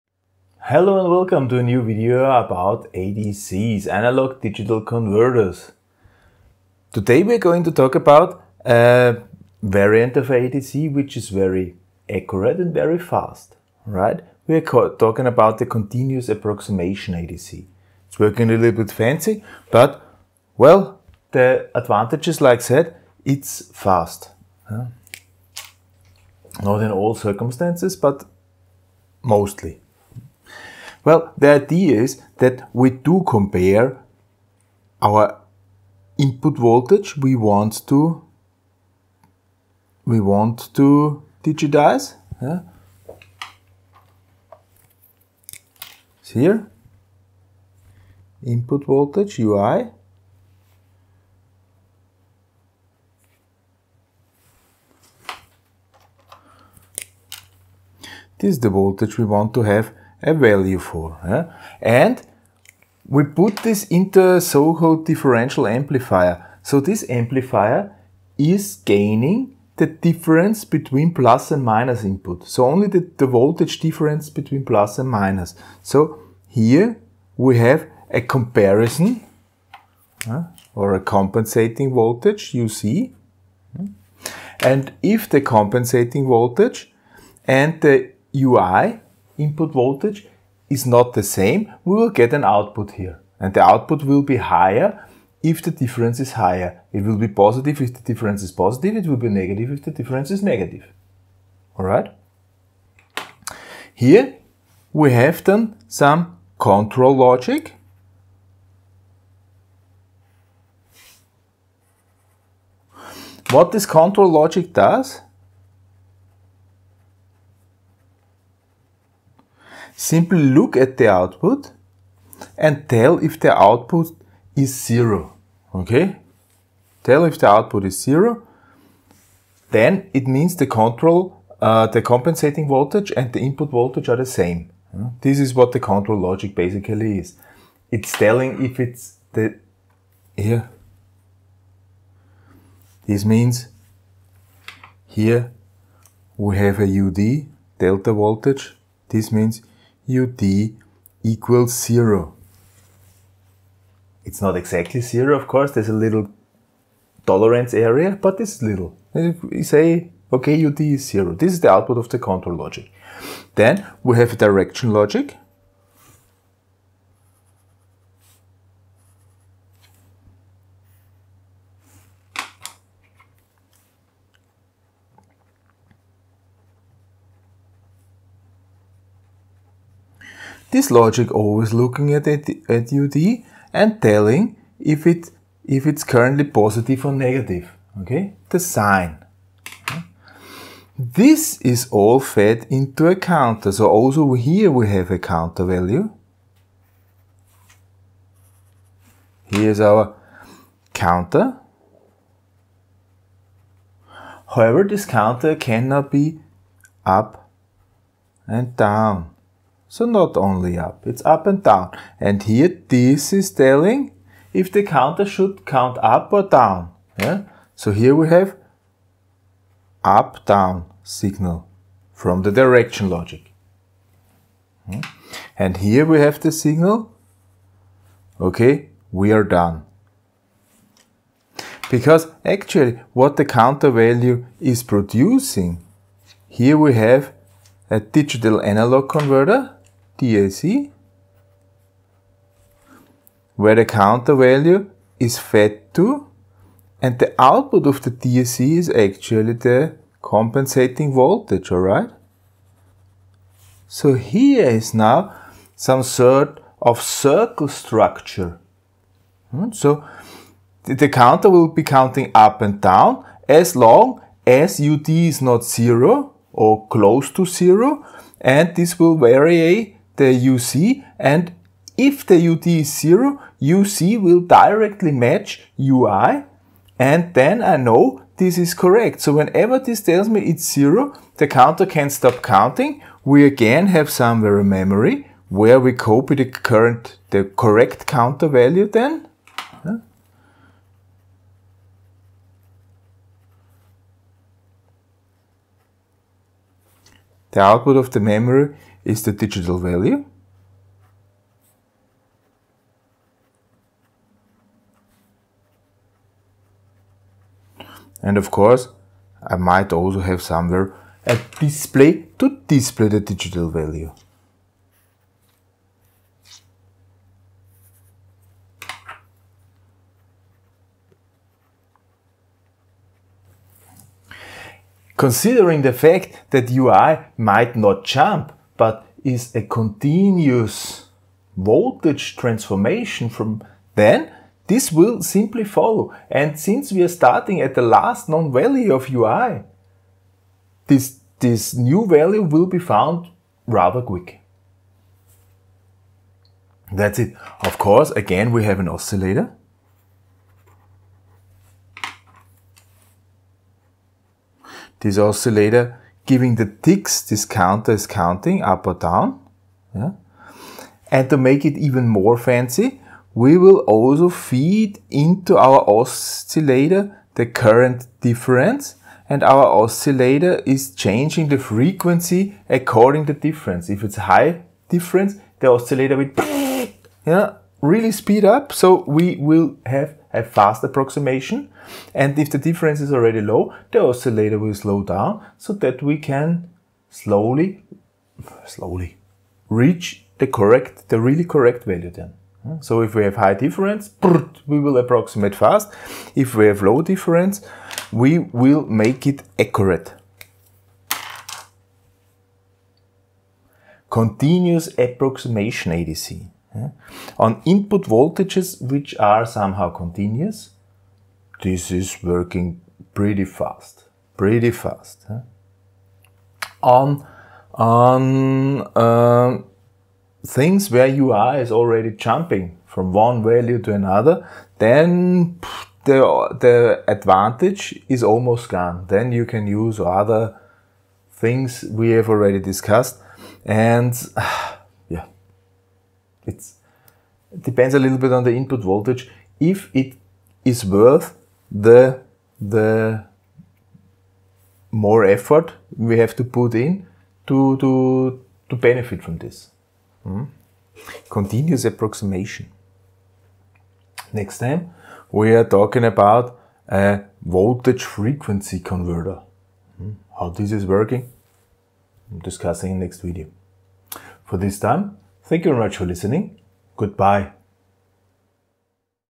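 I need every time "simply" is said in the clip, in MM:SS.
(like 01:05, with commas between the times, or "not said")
01:59, 05:35.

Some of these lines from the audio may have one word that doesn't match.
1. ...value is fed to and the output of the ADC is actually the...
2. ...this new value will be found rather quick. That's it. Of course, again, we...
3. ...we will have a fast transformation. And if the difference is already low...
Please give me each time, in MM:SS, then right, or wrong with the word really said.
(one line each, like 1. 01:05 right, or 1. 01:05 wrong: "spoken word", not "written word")
1. 04:04 wrong: "DAC", not "ADC"
2. 05:41 right
3. 06:19 wrong: "approximation", not "transformation".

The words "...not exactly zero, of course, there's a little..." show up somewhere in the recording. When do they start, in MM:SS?
02:34.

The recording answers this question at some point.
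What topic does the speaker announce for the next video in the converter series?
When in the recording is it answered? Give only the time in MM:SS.
07:37.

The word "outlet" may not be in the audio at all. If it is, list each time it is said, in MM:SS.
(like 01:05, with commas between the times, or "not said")
not said.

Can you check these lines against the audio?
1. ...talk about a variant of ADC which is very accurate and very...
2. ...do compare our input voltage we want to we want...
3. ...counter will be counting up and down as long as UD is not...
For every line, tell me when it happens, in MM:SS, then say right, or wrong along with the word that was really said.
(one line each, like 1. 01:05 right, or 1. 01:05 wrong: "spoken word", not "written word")
1. 00:07 right
2. 00:32 right
3. 04:21 right.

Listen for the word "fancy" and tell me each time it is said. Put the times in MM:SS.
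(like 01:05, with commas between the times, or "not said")
00:18, 06:02.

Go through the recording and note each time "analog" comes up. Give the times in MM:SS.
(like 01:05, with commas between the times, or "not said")
00:03, 03:58.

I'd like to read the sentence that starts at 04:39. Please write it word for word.
So whenever this tells me it's 0, the counter can stop counting.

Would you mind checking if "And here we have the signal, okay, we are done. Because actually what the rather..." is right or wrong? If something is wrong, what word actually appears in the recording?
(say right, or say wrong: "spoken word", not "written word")
wrong: "counter", not "rather".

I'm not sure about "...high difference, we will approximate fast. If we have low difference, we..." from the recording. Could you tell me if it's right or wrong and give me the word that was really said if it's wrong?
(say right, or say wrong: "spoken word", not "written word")
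right.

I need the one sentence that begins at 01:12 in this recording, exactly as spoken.
So only the, the voltage difference between plus and minus.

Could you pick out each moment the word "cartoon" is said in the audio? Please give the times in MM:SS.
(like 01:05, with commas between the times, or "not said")
not said.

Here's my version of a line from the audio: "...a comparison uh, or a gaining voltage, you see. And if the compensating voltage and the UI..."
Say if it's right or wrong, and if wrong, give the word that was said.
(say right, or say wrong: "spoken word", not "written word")
wrong: "compensating", not "gaining".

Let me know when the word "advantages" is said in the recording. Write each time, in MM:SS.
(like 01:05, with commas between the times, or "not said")
00:21, 07:07.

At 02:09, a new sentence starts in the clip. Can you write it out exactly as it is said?
Then it means the control, uh, the compensating voltage and the input voltage are the same.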